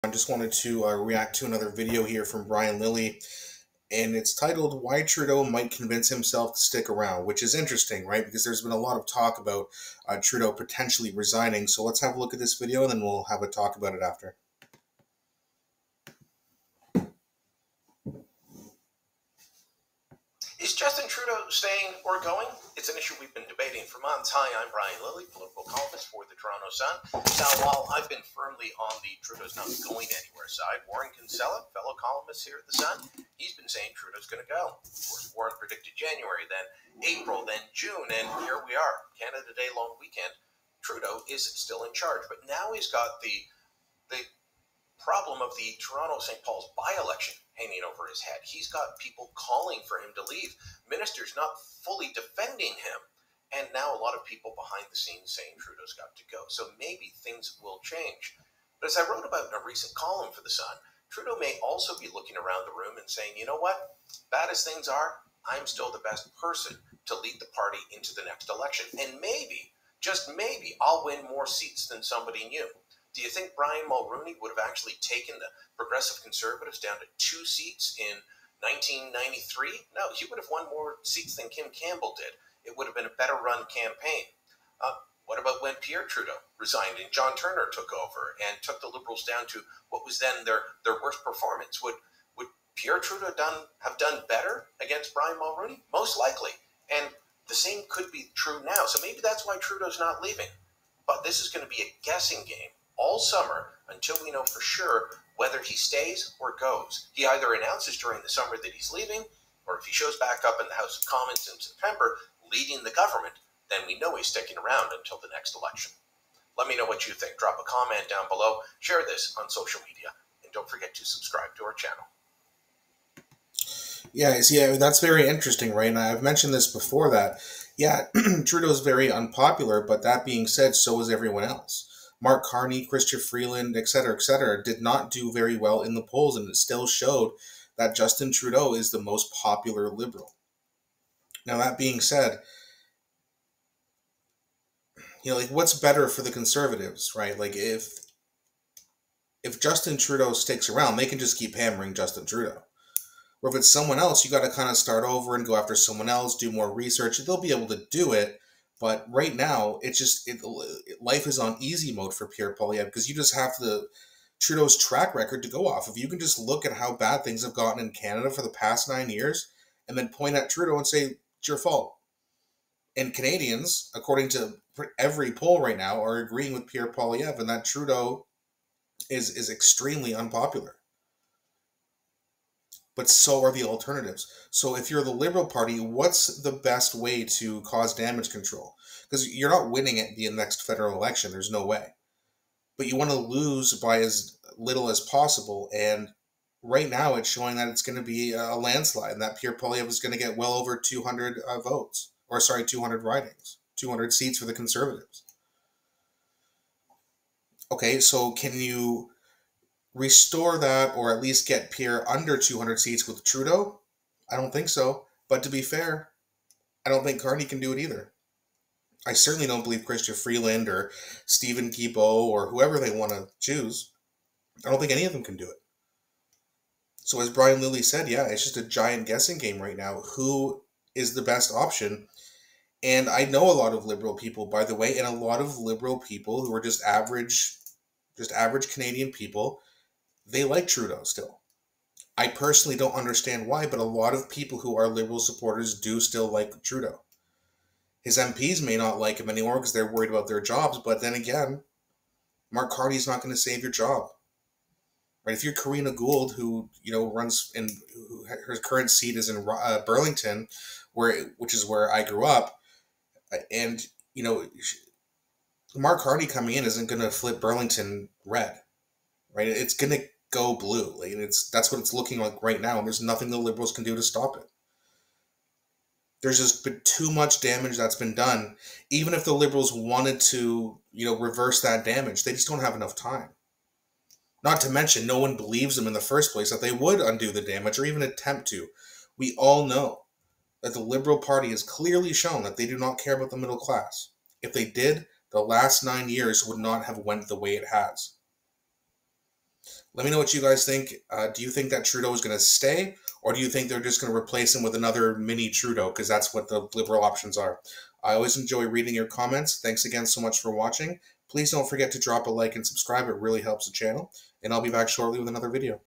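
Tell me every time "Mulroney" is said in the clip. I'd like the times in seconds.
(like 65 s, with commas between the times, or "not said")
73 s, 95 s.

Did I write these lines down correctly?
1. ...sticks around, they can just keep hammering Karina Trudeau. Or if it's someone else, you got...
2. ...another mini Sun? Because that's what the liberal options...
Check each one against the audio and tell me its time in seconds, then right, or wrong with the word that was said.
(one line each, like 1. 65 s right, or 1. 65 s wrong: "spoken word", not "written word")
1. 150 s wrong: "Justin", not "Karina"
2. 304 s wrong: "Trudeau", not "Sun".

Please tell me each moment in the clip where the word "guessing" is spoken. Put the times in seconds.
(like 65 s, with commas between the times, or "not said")
102 s, 229 s.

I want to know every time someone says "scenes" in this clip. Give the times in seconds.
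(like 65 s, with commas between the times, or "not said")
54 s.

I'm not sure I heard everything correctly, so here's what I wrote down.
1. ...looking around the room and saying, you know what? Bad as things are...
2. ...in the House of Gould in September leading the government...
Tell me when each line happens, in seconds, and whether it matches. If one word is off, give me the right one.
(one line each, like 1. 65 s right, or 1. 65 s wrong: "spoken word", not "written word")
1. 62 s right
2. 110 s wrong: "Commons", not "Gould".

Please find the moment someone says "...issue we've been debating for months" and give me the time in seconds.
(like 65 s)
22 s.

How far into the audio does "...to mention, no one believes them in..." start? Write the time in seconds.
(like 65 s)
284 s.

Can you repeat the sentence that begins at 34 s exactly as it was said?
Of course, Warren predicted January, then April, then June, and here we are.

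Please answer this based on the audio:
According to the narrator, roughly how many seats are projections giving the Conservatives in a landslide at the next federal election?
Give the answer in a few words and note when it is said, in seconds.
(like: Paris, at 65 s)
over 200, at 200 s.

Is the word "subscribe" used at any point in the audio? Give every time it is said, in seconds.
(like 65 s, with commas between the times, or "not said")
121 s, 312 s.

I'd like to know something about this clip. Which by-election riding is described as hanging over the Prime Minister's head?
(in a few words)
Toronto St. Paul's.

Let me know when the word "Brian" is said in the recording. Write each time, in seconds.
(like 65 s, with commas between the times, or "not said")
2 s, 24 s, 73 s, 95 s, 227 s.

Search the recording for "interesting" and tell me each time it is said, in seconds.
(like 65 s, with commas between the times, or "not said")
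7 s, 125 s.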